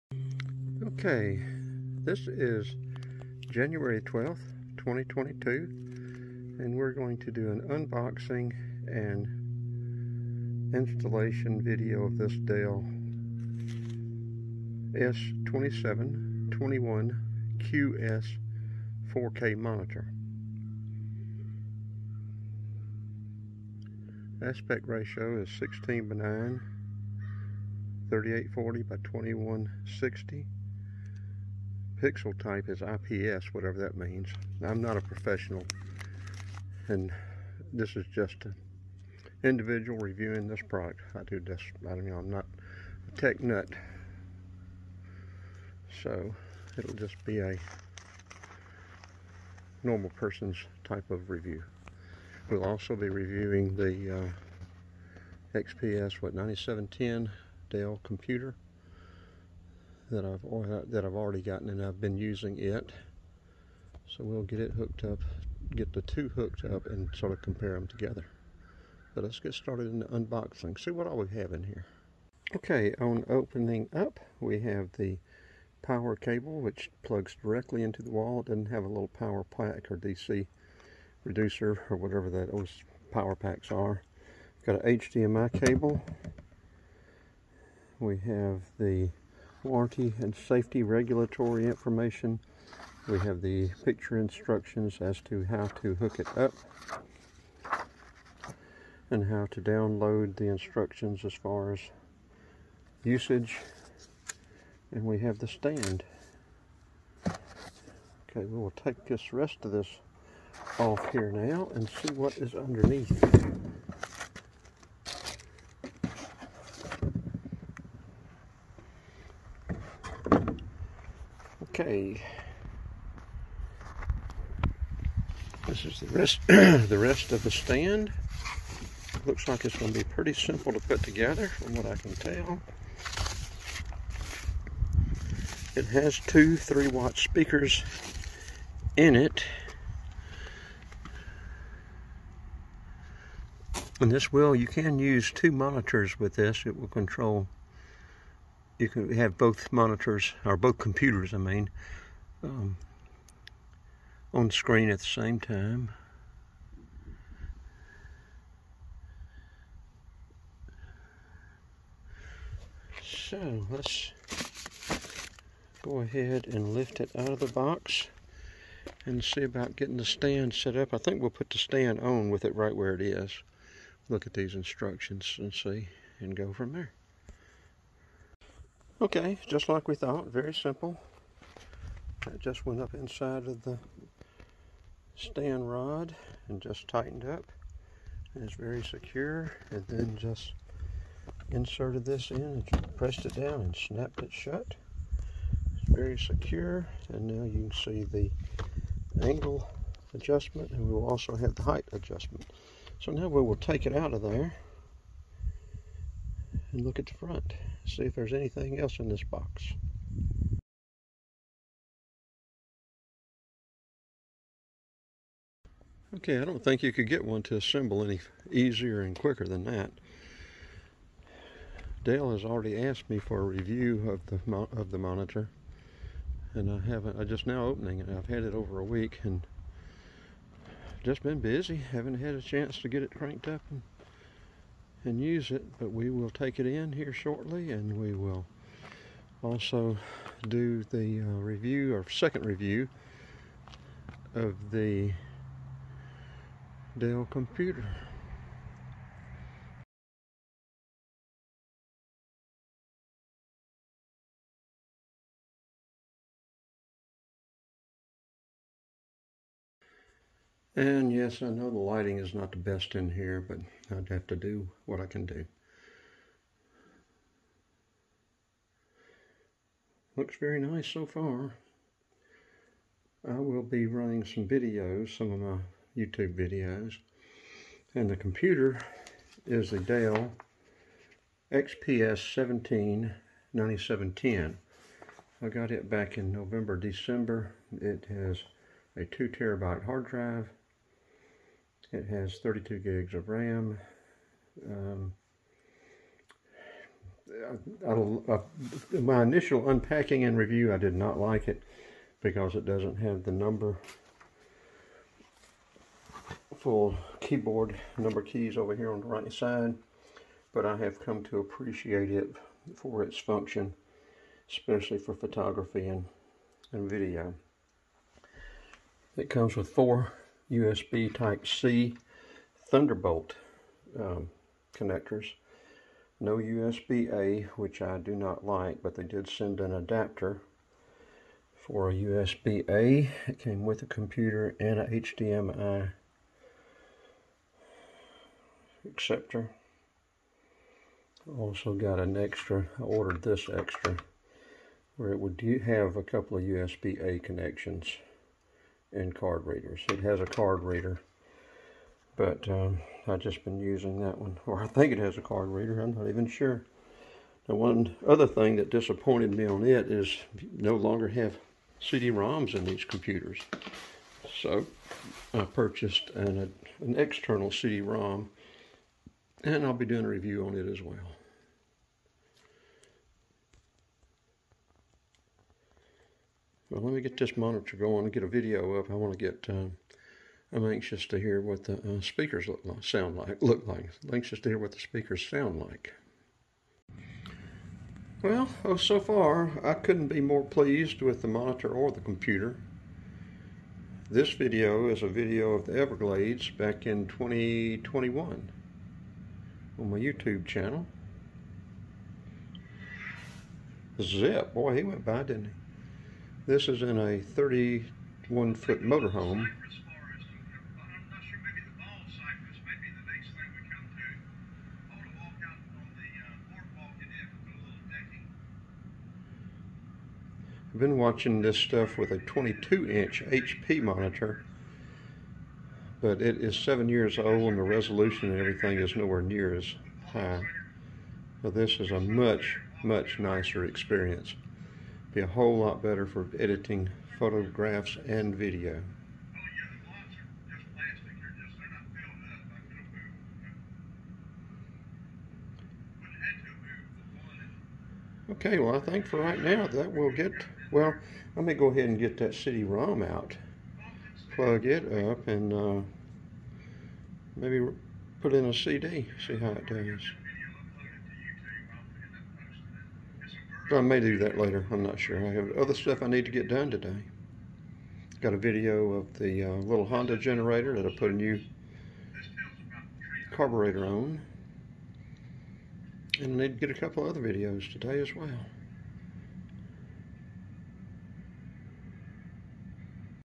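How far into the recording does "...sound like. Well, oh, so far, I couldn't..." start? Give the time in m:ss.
6:25.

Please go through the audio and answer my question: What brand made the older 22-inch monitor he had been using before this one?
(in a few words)
HP.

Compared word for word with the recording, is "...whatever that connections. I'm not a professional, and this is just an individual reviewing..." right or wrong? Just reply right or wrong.
wrong.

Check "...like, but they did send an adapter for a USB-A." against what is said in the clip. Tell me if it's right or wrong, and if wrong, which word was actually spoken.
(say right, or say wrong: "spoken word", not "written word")
right.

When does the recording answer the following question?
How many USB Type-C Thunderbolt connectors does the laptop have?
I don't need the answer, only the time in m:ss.
5:19.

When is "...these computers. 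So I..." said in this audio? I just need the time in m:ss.
6:02.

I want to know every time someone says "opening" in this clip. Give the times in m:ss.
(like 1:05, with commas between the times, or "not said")
1:13, 3:47.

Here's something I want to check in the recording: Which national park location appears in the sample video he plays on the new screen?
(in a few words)
Everglades.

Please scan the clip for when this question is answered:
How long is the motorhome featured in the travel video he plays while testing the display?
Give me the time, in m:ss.
6:47.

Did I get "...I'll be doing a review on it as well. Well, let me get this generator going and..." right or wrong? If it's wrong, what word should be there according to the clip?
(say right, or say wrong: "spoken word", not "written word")
wrong: "monitor", not "generator".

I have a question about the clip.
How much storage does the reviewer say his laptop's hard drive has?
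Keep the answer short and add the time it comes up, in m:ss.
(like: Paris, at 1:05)
2 terabytes, at 4:49.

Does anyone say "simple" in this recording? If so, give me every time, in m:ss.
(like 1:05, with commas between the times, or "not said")
2:10, 3:00.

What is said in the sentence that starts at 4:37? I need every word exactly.
And the computer is the Dell XPS 179710.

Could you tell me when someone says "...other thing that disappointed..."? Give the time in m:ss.
5:58.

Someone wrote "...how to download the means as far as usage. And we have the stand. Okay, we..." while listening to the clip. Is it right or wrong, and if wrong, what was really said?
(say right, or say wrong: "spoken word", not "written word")
wrong: "instructions", not "means".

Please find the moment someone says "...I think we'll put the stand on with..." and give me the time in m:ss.
2:50.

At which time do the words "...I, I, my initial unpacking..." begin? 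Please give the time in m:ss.
4:57.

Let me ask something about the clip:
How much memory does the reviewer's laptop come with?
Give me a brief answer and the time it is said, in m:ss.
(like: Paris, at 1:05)
32 gigs, at 4:52.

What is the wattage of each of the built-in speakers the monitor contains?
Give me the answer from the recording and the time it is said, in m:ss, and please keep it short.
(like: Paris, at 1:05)
3 watts, at 2:16.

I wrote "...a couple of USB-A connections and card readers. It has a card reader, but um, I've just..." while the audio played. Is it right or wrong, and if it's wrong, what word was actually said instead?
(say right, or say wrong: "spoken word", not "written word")
right.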